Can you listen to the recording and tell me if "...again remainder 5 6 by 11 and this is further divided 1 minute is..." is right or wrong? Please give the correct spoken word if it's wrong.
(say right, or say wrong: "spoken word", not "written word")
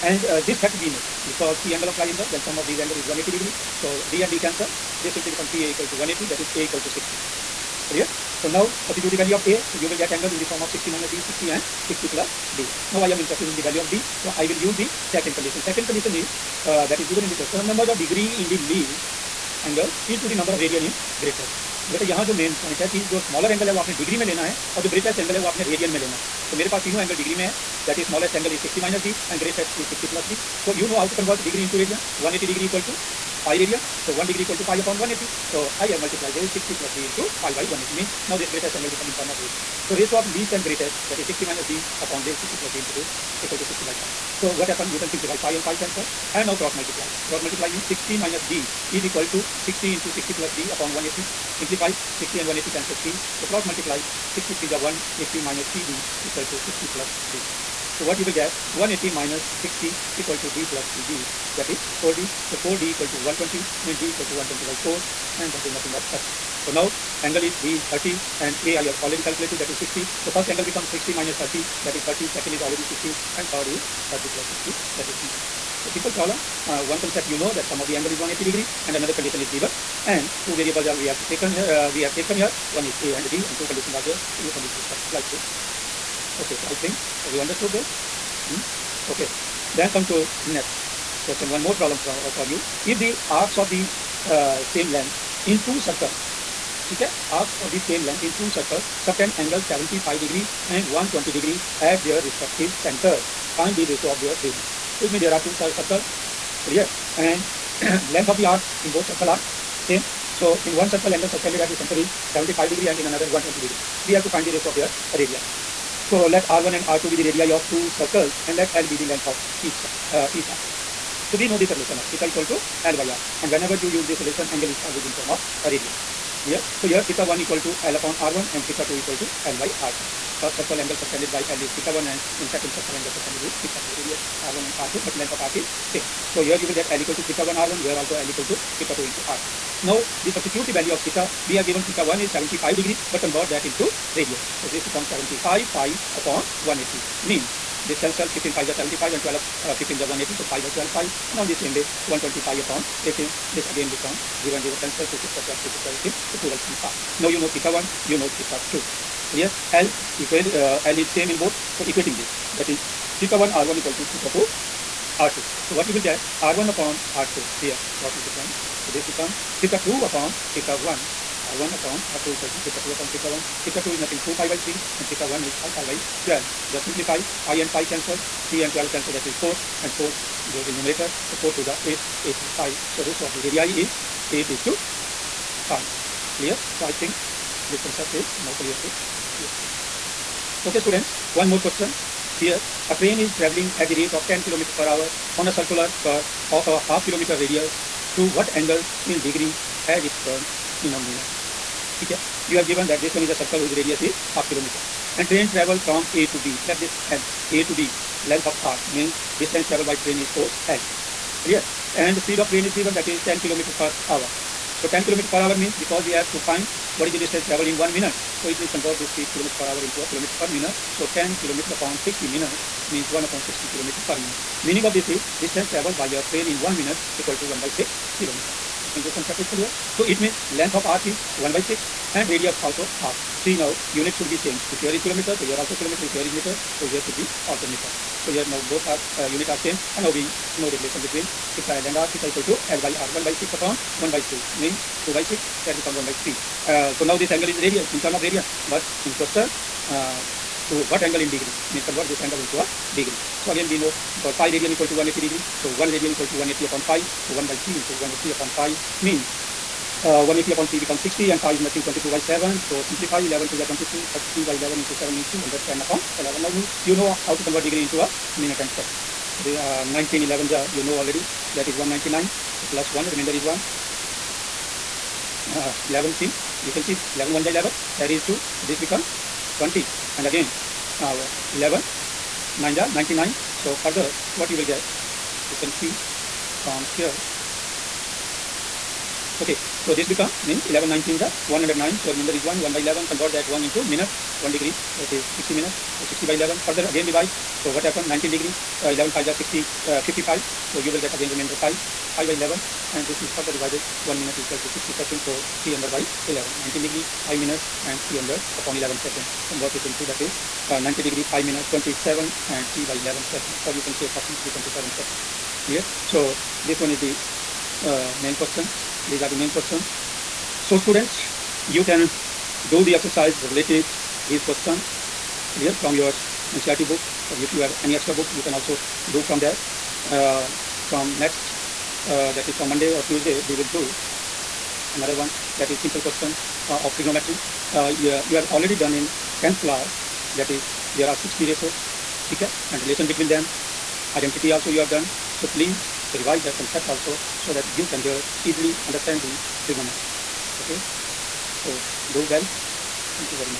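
wrong: "5", not "6".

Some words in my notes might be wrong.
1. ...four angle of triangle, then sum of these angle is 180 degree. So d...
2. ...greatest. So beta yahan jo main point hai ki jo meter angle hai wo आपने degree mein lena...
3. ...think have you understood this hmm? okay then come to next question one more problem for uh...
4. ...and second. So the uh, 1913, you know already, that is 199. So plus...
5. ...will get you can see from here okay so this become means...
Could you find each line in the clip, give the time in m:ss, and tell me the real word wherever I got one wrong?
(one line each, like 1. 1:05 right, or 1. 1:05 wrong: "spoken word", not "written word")
1. 0:01 wrong: "three", not "four"
2. 0:21 wrong: "smaller", not "meter"
3. 1:26 right
4. 4:28 wrong: "1911", not "1913"
5. 4:44 right.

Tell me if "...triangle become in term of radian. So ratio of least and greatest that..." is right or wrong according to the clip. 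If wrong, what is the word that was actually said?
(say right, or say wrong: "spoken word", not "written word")
wrong: "angle", not "triangle".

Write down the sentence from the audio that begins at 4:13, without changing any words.
So again, we know because pi radian equal to 180 degree.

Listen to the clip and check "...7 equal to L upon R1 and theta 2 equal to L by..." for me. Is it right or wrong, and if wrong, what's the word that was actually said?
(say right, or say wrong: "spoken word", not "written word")
wrong: "1", not "7".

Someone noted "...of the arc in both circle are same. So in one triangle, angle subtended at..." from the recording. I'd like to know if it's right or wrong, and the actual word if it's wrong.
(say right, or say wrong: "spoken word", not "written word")
wrong: "circle", not "triangle".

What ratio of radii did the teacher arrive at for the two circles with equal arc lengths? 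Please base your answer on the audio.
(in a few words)
8 is to 5.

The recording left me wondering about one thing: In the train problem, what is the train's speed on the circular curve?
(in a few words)
10 km per hour.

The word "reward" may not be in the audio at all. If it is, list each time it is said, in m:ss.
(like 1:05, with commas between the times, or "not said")
not said.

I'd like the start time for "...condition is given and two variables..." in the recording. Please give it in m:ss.
1:19.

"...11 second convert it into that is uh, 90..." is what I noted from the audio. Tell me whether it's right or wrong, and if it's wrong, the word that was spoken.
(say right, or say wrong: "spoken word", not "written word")
right.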